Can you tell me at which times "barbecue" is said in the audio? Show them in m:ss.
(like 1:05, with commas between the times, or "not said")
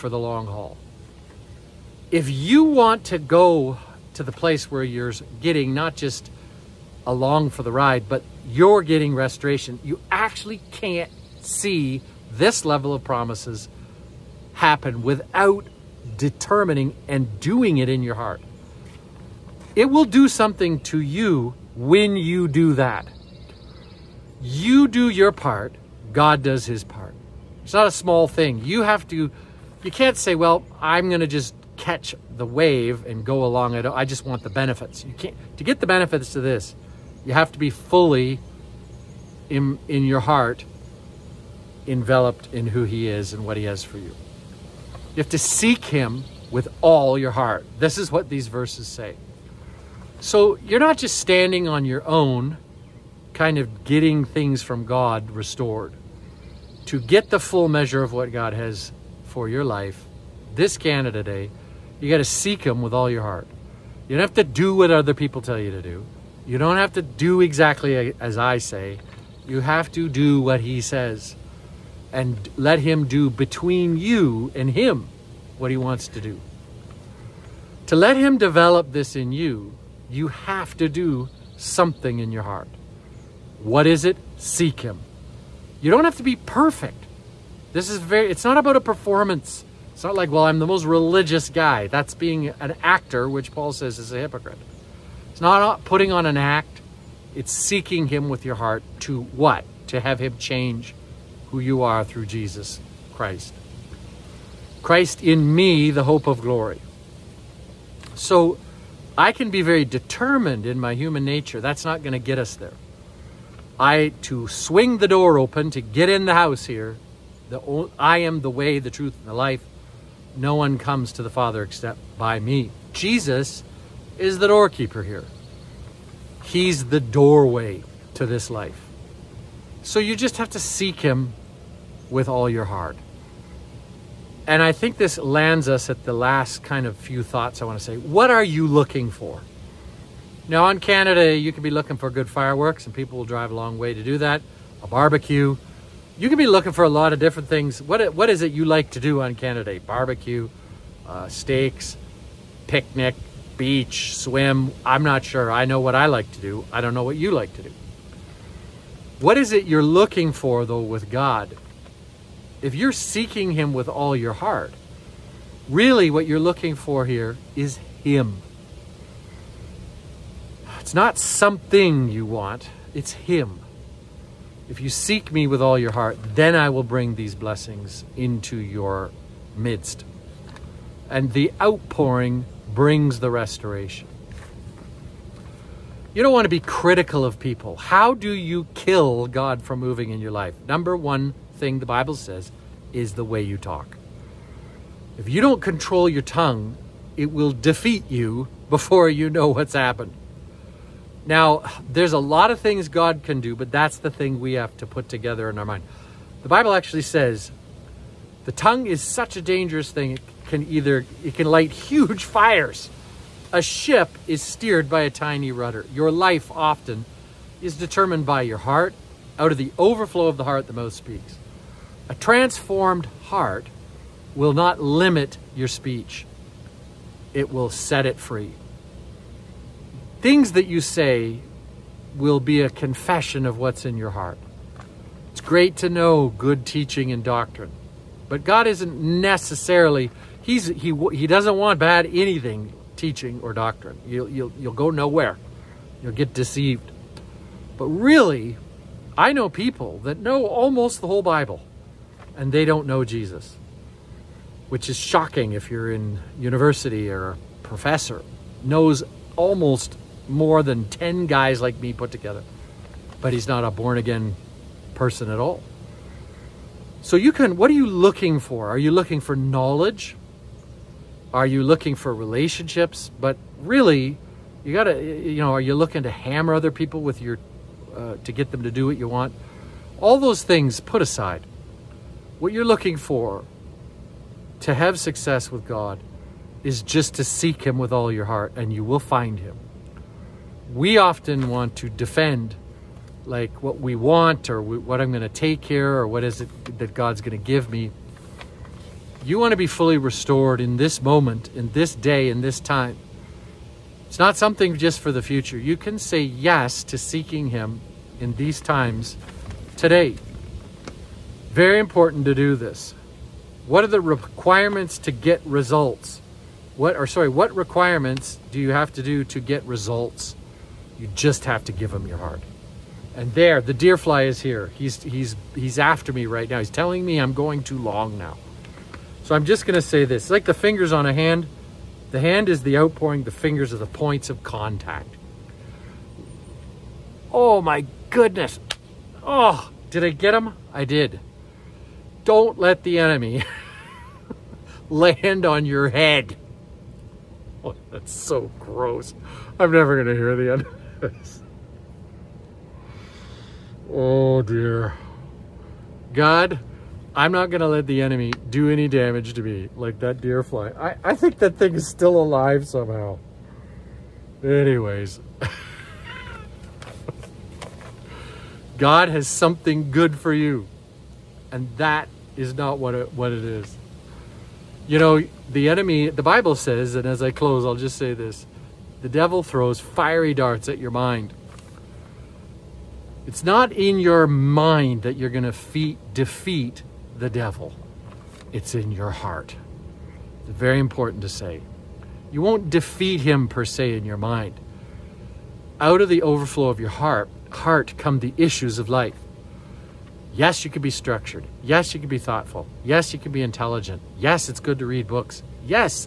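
2:24, 2:29.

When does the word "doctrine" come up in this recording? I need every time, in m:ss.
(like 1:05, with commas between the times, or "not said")
3:57, 4:03.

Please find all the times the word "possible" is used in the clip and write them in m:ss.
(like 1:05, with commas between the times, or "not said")
not said.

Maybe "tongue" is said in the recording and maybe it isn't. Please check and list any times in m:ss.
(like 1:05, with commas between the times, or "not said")
3:16, 3:28.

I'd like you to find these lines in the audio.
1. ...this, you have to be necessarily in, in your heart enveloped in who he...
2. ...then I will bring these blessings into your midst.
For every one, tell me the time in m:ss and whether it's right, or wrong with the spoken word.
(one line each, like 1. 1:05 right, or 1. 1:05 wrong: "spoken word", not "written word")
1. 0:36 wrong: "fully", not "necessarily"
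2. 2:56 right.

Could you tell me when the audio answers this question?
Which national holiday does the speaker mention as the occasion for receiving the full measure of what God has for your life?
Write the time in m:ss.
1:00.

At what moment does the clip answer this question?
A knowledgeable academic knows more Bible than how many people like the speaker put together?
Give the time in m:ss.
4:20.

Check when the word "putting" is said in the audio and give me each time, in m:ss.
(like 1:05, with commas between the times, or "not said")
1:35.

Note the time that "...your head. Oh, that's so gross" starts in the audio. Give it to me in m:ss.
5:45.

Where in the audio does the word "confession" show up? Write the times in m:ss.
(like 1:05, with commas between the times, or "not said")
3:52.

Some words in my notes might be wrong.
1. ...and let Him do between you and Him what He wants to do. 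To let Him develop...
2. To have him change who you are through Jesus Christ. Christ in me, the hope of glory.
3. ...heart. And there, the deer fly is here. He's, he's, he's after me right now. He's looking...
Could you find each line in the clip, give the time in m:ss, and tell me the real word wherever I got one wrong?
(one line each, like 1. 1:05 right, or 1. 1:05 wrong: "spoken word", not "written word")
1. 1:12 right
2. 1:39 right
3. 5:22 wrong: "telling", not "looking".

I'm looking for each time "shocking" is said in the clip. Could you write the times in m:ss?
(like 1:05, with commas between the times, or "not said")
4:14.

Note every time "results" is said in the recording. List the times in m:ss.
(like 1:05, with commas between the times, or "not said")
5:15, 5:19.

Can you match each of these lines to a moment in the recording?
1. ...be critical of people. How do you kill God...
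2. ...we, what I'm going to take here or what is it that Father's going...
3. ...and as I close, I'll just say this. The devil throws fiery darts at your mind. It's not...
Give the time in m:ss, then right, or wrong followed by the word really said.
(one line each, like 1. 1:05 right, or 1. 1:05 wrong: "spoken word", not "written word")
1. 3:06 right
2. 4:54 wrong: "God", not "Father"
3. 6:16 right.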